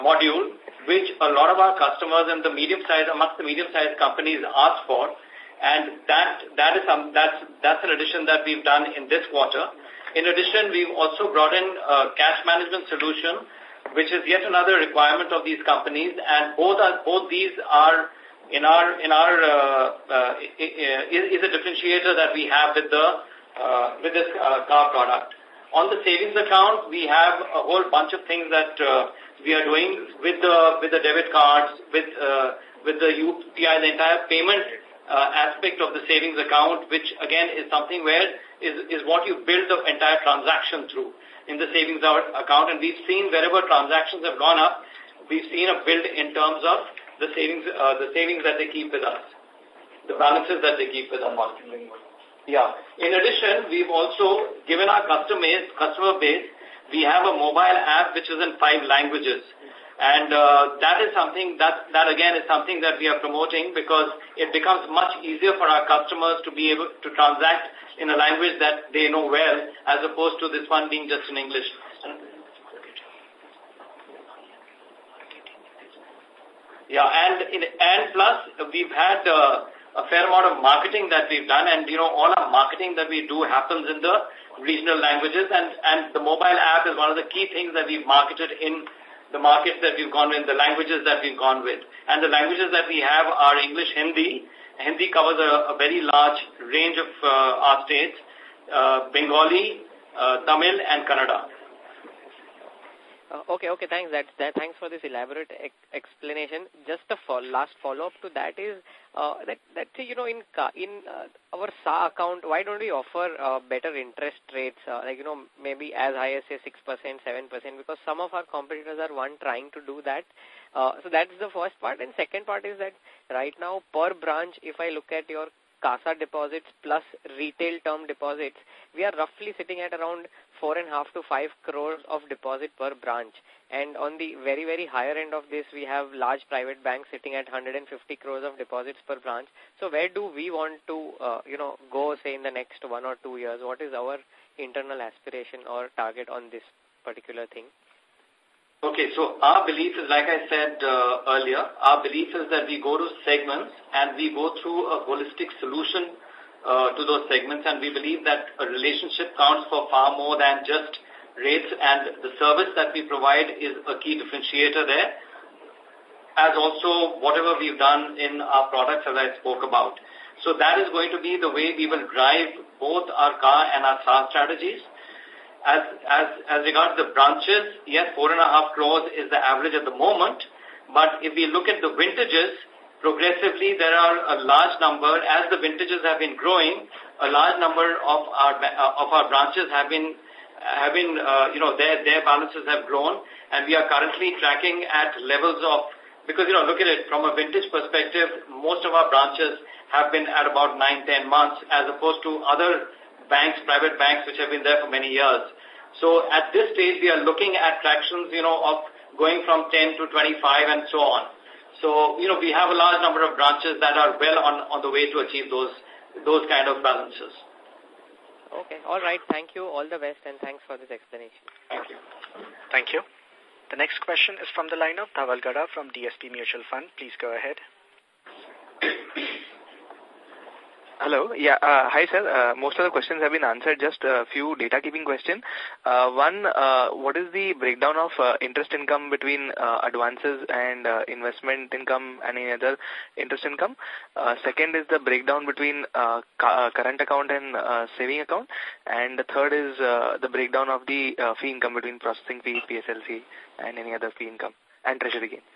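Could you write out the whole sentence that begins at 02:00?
Uh, so that's the first part.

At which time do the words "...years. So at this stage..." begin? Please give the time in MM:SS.
03:25.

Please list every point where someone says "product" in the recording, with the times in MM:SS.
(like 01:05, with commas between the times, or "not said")
00:24, 02:48.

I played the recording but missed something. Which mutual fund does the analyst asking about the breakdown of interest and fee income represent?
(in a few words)
DSP Mutual Fund.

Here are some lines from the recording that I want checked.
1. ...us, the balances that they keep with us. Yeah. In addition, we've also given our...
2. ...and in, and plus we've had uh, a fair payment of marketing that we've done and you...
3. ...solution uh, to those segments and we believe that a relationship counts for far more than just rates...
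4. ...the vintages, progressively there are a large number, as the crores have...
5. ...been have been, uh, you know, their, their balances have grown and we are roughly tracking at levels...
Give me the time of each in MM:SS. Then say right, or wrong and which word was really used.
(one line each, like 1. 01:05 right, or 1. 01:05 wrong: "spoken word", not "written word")
1. 00:49 right
2. 01:17 wrong: "amount", not "payment"
3. 02:35 right
4. 03:01 wrong: "vintages", not "crores"
5. 03:09 wrong: "currently", not "roughly".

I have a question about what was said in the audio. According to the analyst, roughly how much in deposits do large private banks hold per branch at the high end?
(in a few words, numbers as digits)
150 crores.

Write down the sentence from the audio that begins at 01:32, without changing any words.
And the languages that we have are English, Hindi.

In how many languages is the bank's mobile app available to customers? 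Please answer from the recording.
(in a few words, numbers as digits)
5.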